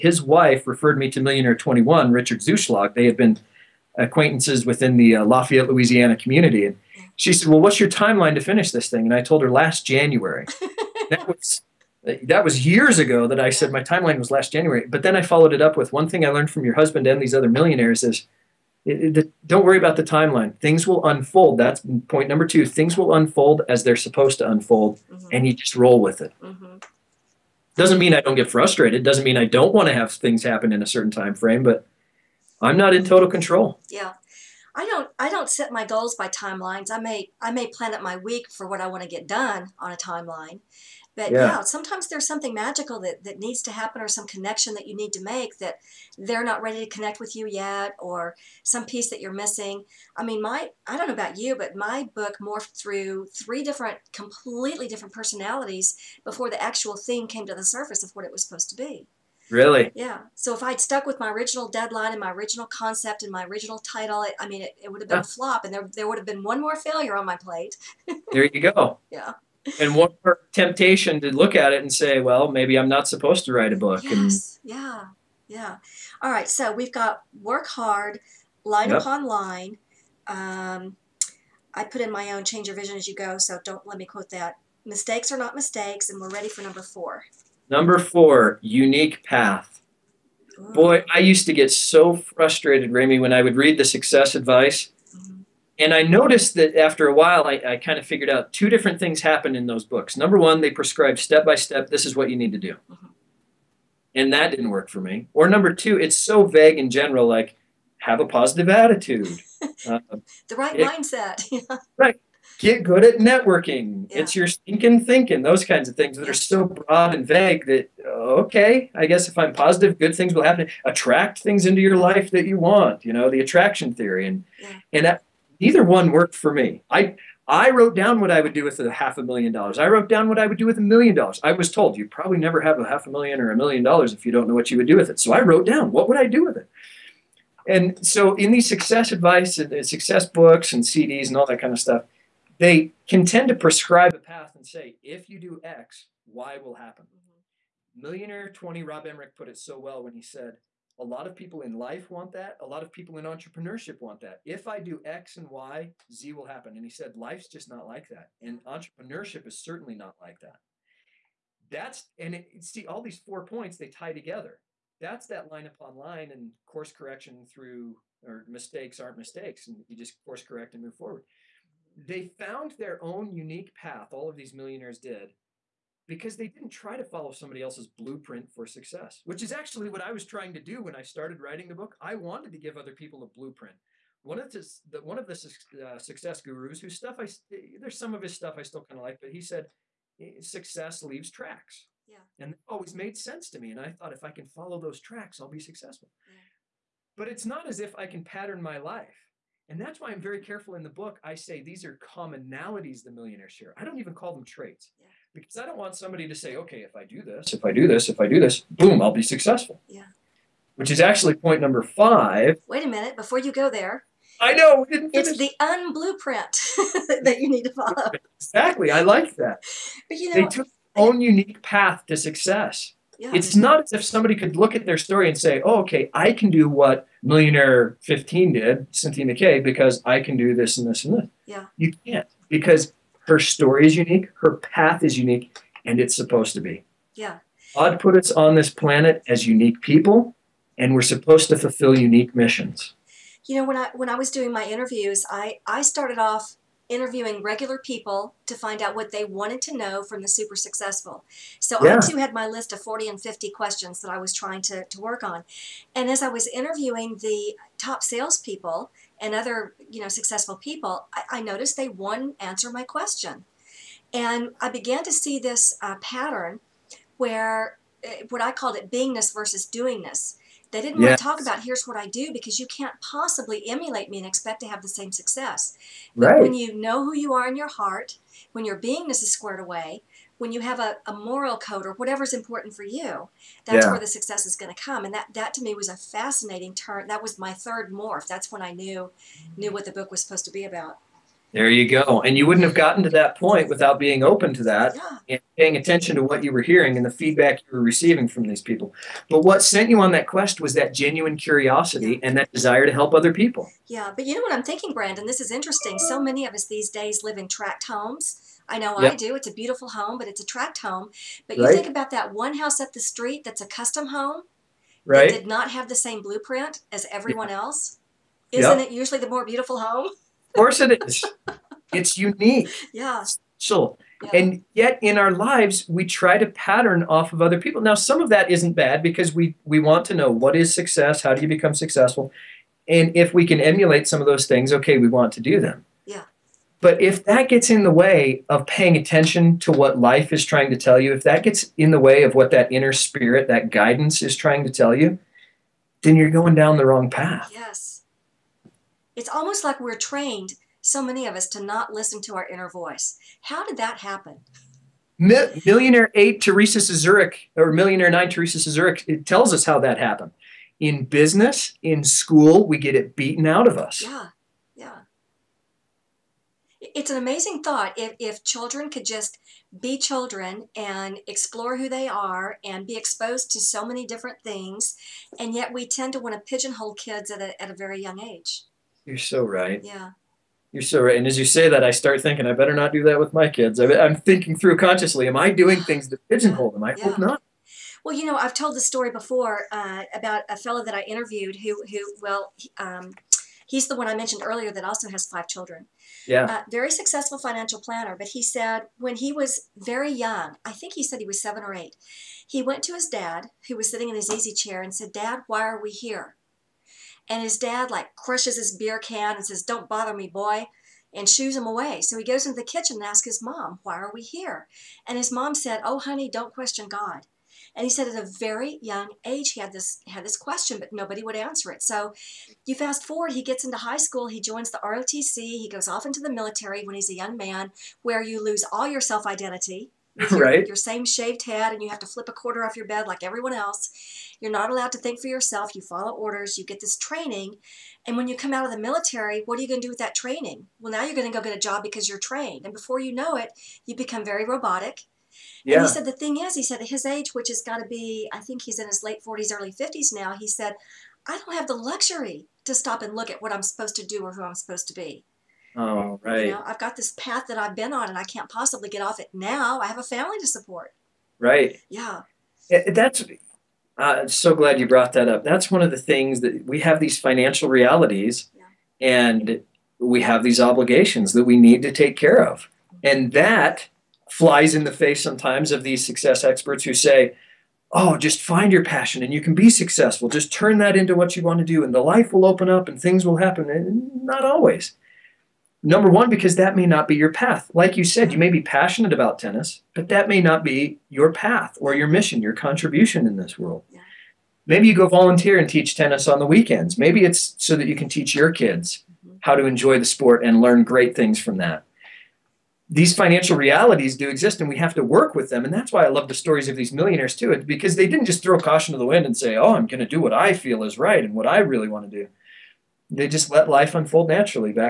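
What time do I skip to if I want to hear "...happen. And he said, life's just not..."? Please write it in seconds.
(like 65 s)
156 s.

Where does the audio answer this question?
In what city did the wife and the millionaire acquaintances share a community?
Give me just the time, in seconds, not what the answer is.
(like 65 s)
5 s.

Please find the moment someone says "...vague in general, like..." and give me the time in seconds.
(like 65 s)
106 s.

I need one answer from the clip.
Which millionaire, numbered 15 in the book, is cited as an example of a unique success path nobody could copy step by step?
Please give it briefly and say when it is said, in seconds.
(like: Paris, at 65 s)
Cynthia McKay, at 228 s.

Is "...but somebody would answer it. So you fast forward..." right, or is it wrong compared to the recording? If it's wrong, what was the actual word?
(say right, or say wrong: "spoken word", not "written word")
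wrong: "nobody", not "somebody".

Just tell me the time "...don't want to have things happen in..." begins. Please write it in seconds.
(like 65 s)
29 s.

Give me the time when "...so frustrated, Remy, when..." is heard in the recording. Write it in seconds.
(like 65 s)
91 s.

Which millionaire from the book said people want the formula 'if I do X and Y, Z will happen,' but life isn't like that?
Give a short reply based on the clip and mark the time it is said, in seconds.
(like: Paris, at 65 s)
Rob Emmerich, at 148 s.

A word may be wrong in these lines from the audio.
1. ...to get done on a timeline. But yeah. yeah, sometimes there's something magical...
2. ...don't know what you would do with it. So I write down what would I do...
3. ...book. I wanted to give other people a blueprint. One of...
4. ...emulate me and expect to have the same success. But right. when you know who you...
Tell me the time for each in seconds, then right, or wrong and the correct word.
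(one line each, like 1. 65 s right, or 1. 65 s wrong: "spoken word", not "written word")
1. 39 s right
2. 134 s wrong: "wrote", not "write"
3. 181 s right
4. 273 s right.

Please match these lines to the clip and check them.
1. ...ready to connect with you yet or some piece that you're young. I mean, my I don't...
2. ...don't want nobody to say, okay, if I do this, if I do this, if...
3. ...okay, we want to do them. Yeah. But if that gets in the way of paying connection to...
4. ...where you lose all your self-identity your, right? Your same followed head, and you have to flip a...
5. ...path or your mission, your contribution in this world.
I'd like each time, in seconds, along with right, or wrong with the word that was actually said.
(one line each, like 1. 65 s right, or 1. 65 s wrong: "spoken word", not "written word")
1. 46 s wrong: "missing", not "young"
2. 205 s wrong: "somebody", not "nobody"
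3. 334 s wrong: "attention", not "connection"
4. 428 s wrong: "shaved", not "followed"
5. 491 s right.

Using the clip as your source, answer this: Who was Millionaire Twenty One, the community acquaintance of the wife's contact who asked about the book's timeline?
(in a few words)
Richard Zuschlag.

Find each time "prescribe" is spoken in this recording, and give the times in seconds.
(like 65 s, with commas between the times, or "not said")
100 s, 143 s.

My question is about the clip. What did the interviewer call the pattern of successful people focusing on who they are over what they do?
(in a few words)
beingness versus doingness.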